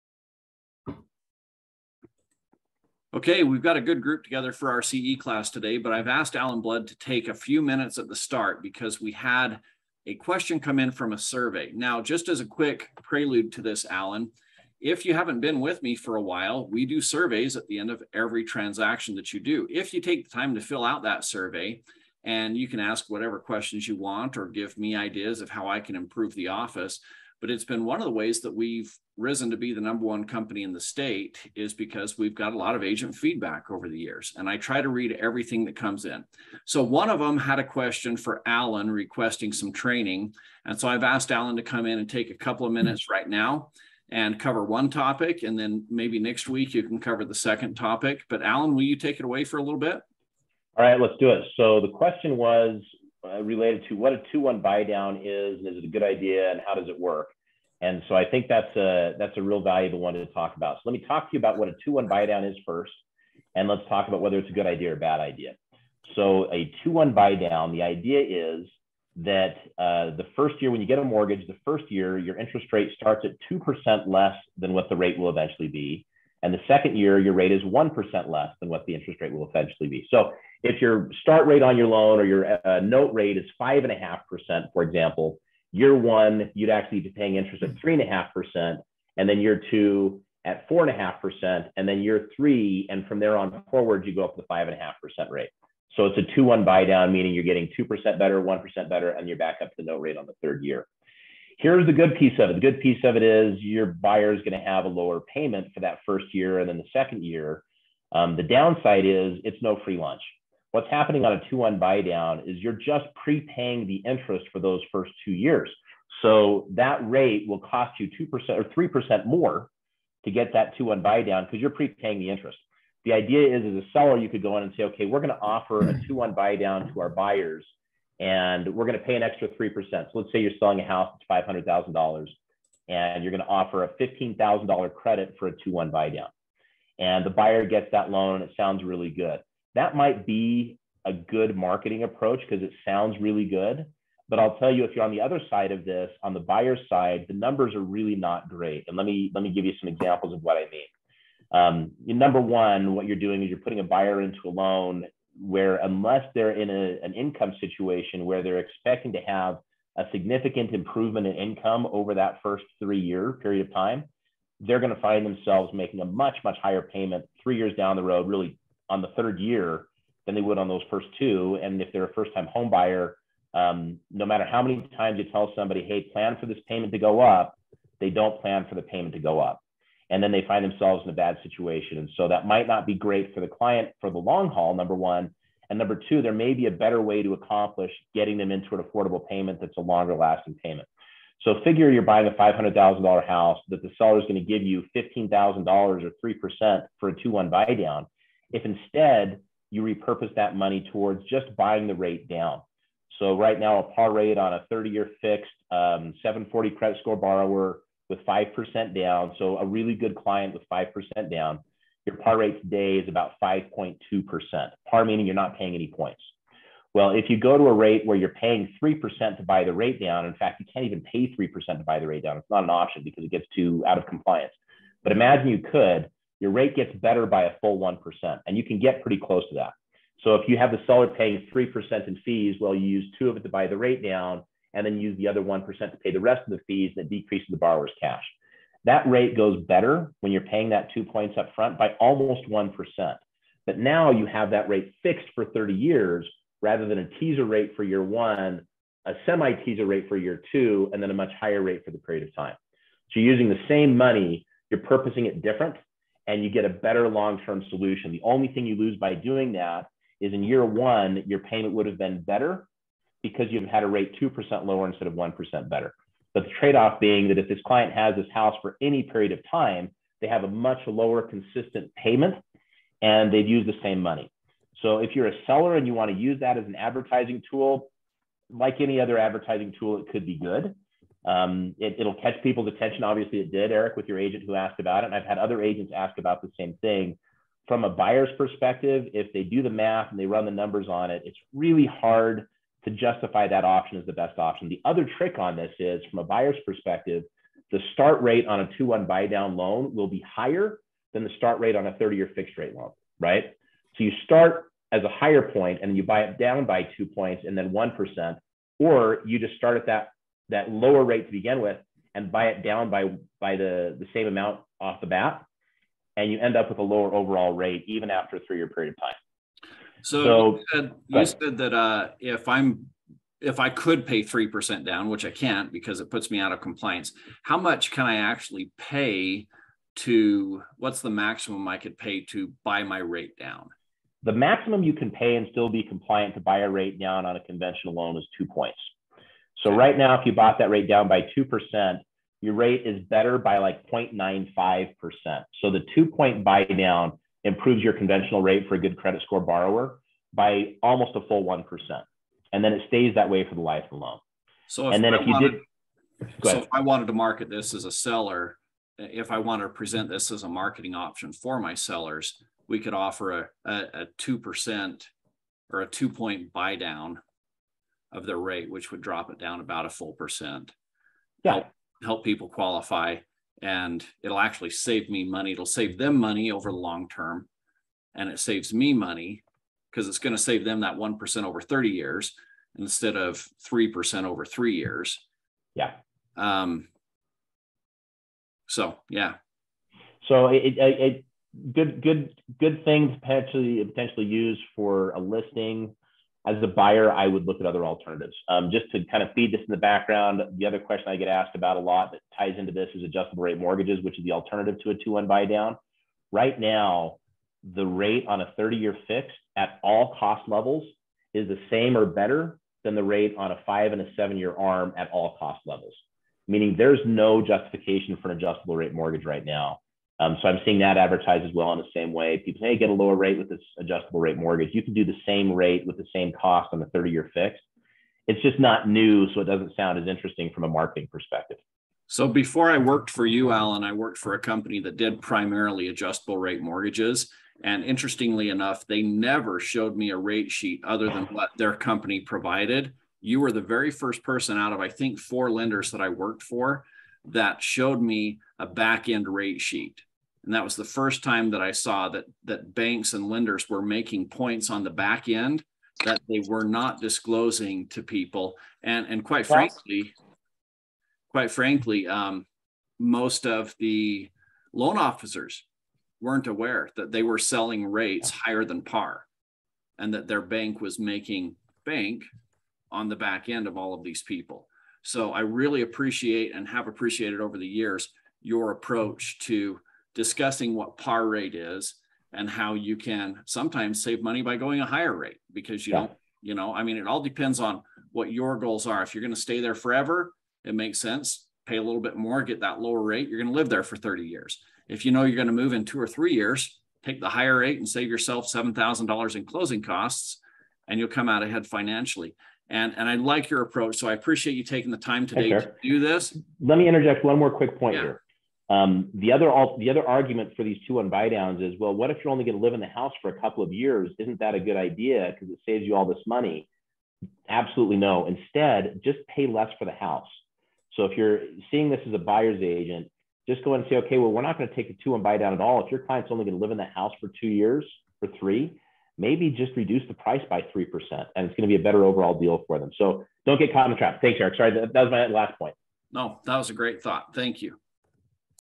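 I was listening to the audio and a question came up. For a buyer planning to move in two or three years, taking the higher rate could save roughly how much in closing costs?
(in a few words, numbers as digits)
$7,000.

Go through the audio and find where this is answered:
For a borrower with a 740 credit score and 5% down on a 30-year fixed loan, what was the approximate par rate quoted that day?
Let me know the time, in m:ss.
3:33.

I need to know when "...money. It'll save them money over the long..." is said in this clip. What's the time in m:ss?
6:15.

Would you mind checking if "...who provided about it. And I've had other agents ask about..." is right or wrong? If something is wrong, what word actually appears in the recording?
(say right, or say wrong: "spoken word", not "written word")
wrong: "asked", not "provided".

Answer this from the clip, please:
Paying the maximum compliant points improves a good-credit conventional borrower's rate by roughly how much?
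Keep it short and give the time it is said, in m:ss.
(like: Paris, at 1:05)
0.95%, at 5:43.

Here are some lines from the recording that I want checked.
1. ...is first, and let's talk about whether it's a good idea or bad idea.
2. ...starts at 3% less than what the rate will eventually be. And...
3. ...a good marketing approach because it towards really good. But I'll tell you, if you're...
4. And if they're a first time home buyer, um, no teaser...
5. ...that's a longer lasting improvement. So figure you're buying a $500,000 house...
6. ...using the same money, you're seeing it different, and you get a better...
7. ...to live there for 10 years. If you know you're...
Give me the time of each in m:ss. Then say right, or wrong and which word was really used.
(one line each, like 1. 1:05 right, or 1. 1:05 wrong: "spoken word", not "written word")
1. 1:02 right
2. 1:12 wrong: "2", not "3"
3. 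2:21 wrong: "sounds", not "towards"
4. 2:51 wrong: "matter", not "teaser"
5. 3:09 wrong: "payment", not "improvement"
6. 4:13 wrong: "purposing", not "seeing"
7. 8:13 wrong: "30", not "10".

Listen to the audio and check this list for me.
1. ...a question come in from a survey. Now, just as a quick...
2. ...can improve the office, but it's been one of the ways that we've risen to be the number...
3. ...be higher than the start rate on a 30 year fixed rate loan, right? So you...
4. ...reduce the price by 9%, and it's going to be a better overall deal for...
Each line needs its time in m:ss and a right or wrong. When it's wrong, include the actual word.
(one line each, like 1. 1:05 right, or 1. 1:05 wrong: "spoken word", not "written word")
1. 0:10 right
2. 0:25 right
3. 5:00 right
4. 8:49 wrong: "3", not "9".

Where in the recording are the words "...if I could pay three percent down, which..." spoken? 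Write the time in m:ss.
5:23.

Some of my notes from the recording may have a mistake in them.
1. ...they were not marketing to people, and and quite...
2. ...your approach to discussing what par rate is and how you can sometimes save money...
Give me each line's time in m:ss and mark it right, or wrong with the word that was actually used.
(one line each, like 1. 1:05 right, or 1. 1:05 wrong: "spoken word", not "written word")
1. 7:36 wrong: "disclosing", not "marketing"
2. 7:58 right.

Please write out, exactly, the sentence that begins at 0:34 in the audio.
And I try to read everything that comes in.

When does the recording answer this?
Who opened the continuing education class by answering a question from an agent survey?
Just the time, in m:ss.
0:06.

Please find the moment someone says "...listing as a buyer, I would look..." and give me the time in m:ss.
6:35.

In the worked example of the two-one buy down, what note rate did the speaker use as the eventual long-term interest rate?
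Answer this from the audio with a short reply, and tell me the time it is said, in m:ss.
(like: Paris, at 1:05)
5.5%, at 1:23.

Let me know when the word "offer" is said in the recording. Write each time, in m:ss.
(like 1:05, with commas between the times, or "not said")
2:05, 2:13, 6:02.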